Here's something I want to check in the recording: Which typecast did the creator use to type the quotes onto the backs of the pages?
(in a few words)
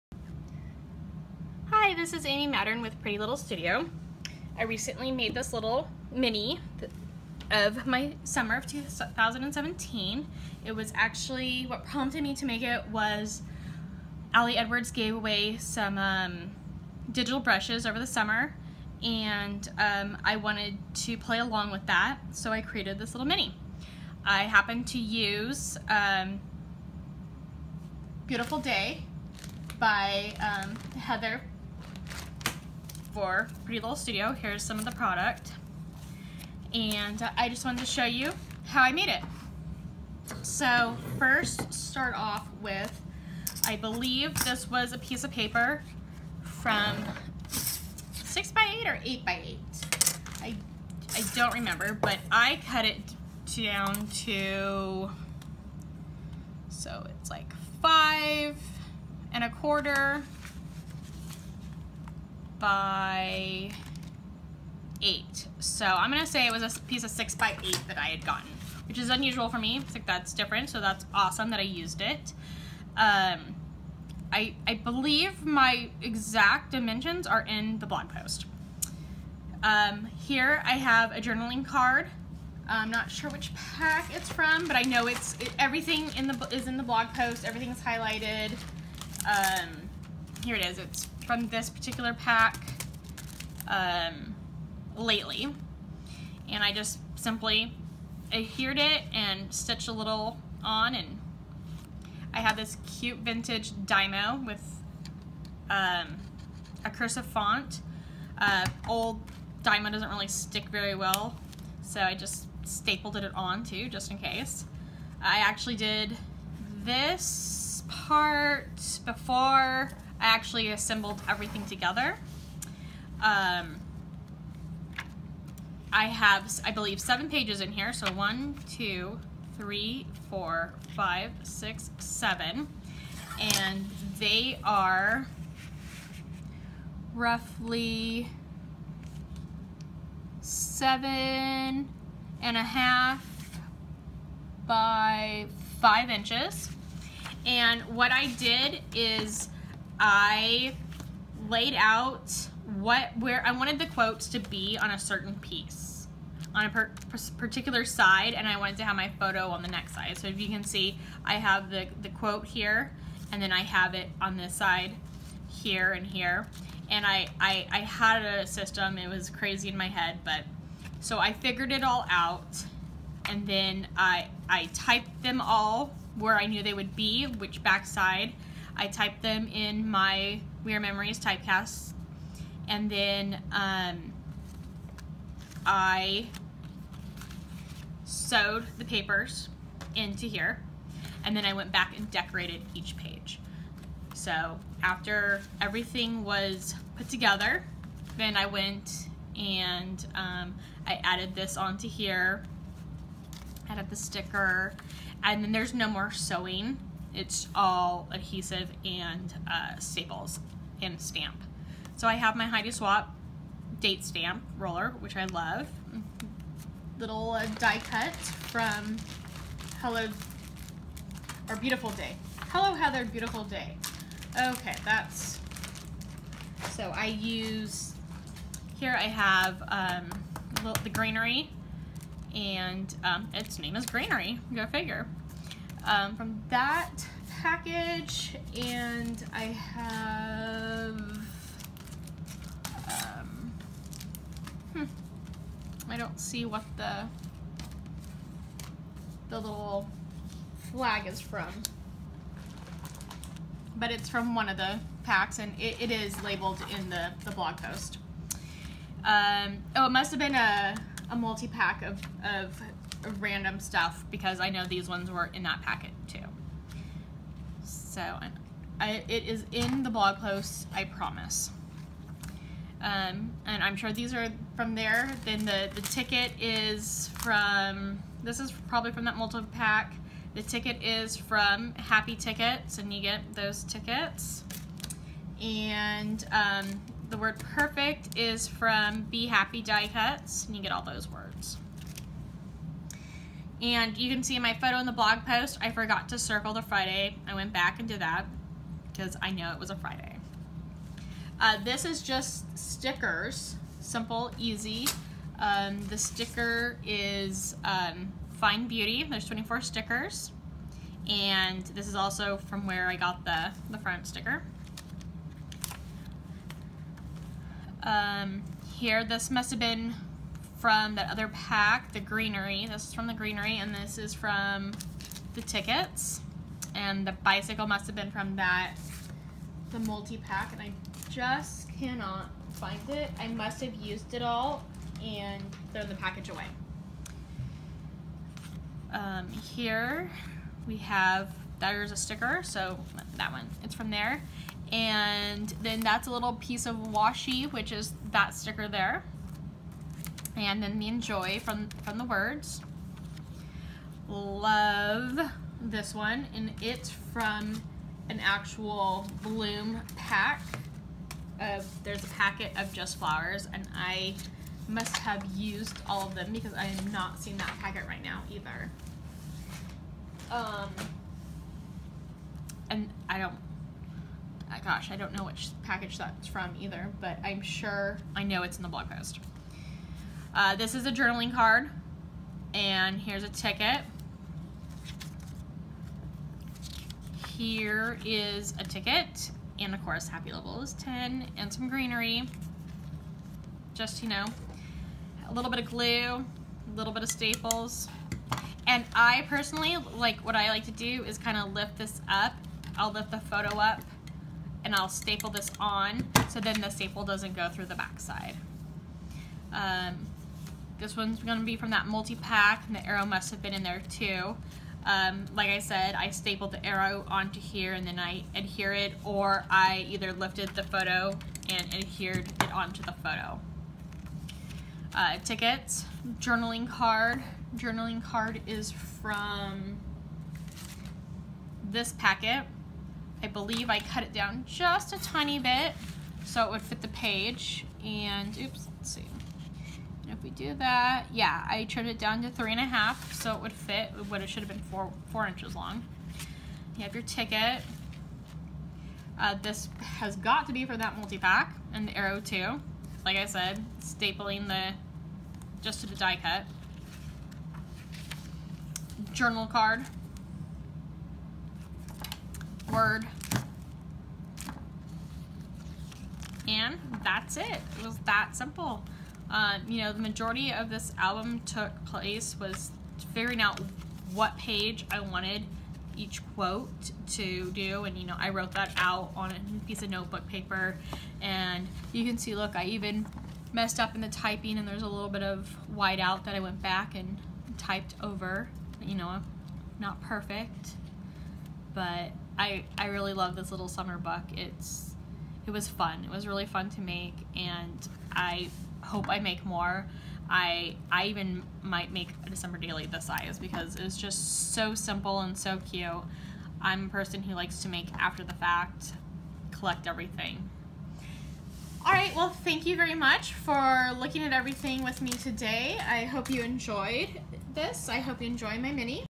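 Weird Memories.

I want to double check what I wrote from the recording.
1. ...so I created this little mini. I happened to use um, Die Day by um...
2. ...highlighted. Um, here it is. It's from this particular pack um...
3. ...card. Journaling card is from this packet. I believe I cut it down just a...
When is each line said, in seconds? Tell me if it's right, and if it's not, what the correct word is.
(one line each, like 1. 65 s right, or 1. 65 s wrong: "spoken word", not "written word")
1. 22 s wrong: "Beautiful", not "Die"
2. 87 s right
3. 426 s right.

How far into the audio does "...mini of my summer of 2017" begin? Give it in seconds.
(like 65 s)
6 s.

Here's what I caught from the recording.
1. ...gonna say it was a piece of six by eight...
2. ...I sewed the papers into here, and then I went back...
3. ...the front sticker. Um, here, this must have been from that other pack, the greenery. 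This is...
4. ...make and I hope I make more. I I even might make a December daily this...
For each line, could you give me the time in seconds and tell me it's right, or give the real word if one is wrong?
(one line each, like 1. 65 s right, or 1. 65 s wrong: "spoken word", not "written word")
1. 66 s right
2. 185 s right
3. 313 s right
4. 496 s right.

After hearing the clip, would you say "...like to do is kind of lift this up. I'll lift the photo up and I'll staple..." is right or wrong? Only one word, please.
right.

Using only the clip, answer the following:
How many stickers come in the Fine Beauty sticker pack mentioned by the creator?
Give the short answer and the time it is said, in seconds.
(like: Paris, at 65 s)
24, at 309 s.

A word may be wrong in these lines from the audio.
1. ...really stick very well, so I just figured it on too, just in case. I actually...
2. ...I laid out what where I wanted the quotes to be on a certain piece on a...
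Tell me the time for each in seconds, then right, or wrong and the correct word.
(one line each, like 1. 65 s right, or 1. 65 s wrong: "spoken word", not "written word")
1. 110 s wrong: "stapled", not "figured"
2. 150 s right.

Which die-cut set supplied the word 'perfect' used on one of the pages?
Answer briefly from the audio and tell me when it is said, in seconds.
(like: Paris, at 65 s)
Be Happy Die Cuts, at 289 s.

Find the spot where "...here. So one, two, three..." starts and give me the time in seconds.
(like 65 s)
127 s.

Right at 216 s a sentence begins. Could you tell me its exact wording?
Little uh, die cut from Hello, or Beautiful Day.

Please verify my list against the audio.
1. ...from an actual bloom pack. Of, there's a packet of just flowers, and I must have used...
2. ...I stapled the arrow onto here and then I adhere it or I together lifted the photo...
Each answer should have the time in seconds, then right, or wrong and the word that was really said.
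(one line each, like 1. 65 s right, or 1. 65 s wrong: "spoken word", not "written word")
1. 357 s right
2. 415 s wrong: "either", not "together".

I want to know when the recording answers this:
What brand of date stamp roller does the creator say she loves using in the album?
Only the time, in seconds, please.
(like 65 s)
212 s.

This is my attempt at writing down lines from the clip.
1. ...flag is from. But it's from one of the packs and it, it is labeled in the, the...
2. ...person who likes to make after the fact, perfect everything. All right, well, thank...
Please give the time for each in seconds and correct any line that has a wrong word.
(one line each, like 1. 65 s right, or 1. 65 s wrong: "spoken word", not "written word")
1. 250 s right
2. 506 s wrong: "collect", not "perfect".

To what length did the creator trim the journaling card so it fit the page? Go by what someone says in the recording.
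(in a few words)
3.5 inches.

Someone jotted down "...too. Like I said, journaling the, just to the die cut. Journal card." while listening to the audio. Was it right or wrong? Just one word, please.
wrong.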